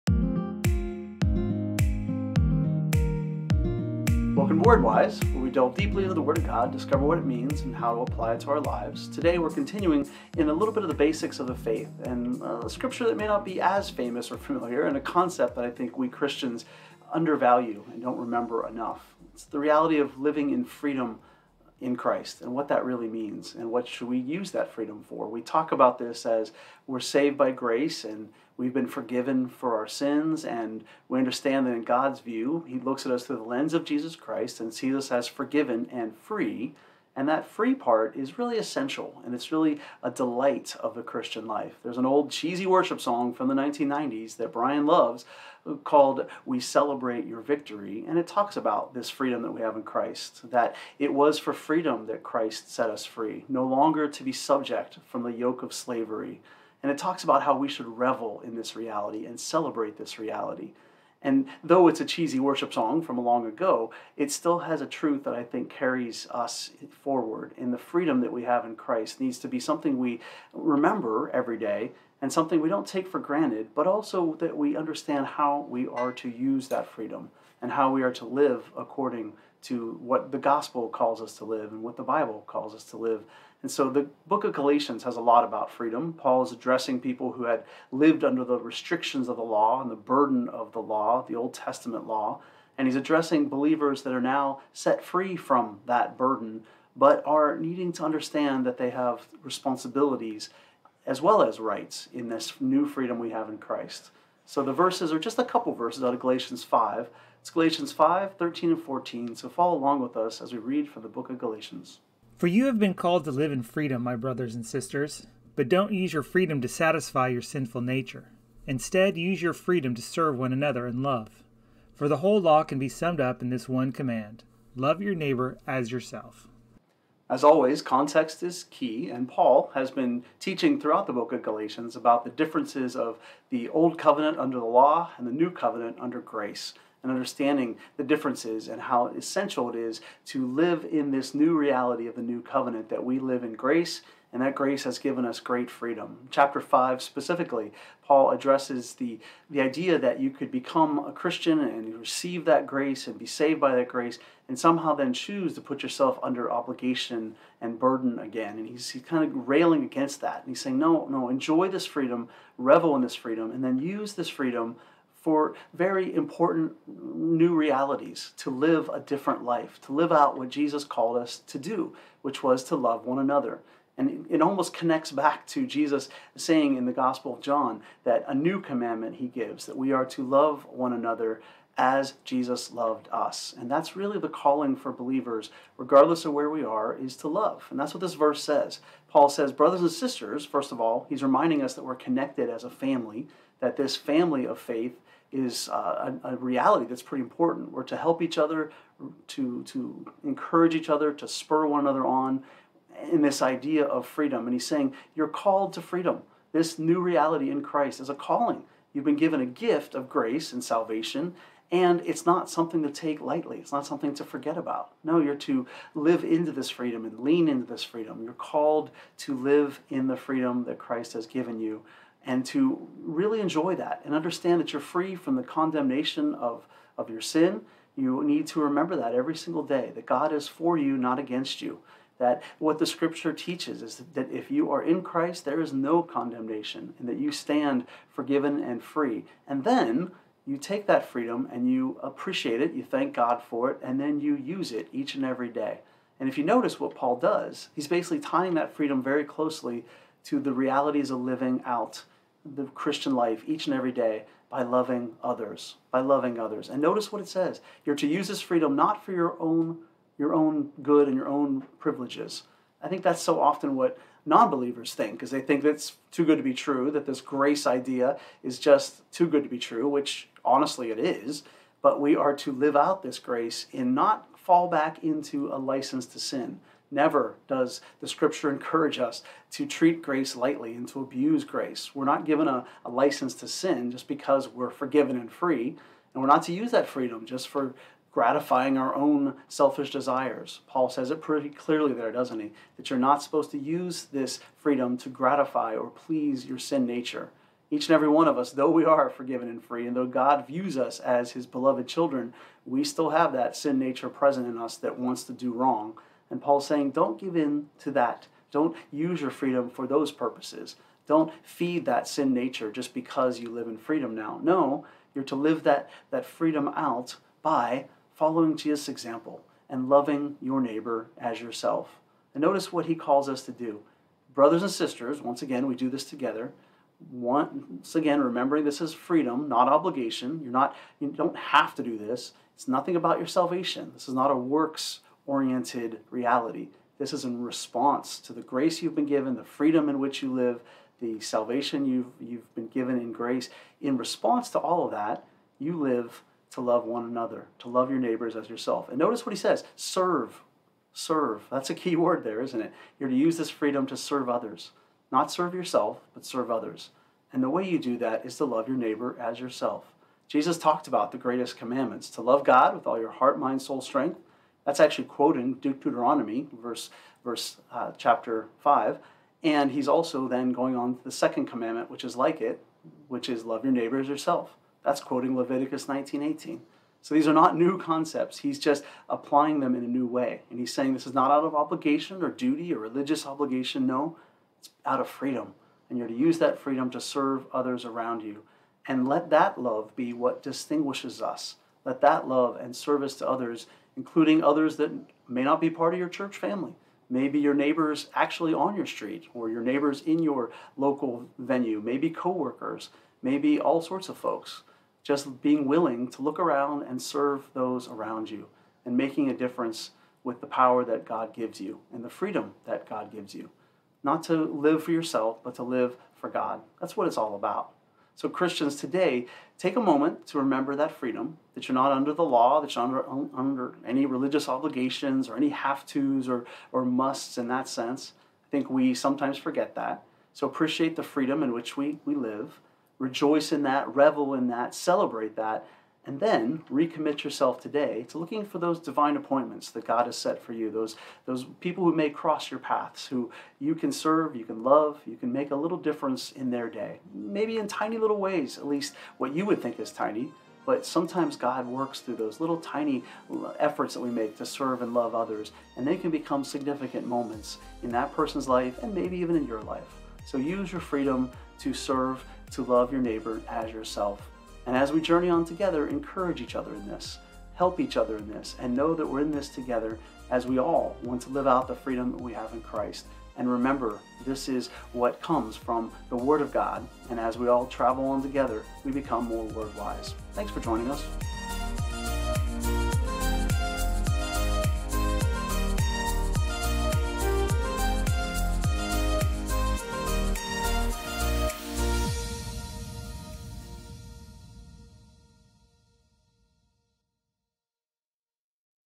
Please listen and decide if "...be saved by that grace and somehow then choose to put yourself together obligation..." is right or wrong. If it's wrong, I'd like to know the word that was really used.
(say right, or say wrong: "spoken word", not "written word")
wrong: "under", not "together".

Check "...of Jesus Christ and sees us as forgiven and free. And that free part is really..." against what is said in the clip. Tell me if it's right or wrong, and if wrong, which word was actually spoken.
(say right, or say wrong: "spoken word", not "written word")
right.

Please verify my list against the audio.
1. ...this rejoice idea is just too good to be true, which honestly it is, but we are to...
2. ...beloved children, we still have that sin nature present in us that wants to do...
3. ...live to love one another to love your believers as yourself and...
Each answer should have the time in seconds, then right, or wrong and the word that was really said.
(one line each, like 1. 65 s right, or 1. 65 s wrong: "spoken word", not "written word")
1. 267 s wrong: "grace", not "rejoice"
2. 301 s right
3. 345 s wrong: "neighbors", not "believers".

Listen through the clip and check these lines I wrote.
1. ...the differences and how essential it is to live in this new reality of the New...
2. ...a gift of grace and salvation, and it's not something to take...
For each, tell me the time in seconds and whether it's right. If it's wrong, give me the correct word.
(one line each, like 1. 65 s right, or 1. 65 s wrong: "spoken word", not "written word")
1. 137 s right
2. 209 s right.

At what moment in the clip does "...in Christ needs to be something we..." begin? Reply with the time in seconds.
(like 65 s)
68 s.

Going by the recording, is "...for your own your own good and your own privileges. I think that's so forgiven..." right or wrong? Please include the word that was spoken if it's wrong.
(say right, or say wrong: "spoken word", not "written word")
wrong: "often", not "forgiven".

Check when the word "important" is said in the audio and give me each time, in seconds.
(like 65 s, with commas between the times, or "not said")
166 s, 197 s.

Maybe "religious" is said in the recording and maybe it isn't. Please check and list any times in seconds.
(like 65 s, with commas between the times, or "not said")
382 s, 424 s.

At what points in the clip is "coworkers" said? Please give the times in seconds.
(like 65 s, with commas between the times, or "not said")
402 s.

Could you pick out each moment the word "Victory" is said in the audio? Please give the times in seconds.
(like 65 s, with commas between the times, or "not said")
47 s.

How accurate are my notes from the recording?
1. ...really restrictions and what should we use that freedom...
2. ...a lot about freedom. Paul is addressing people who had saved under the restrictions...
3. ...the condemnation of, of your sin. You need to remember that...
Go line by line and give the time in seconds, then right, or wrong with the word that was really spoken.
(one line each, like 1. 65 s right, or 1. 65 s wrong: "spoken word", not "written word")
1. 22 s wrong: "means", not "restrictions"
2. 85 s wrong: "lived", not "saved"
3. 225 s right.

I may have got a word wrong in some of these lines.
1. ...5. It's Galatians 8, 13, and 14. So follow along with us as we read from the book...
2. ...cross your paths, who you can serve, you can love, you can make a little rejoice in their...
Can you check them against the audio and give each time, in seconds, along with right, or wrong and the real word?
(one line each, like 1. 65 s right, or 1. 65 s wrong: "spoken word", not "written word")
1. 106 s wrong: "5", not "8"
2. 442 s wrong: "difference", not "rejoice".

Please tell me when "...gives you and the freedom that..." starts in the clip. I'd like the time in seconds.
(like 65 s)
411 s.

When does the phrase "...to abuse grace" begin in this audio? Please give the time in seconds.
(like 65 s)
280 s.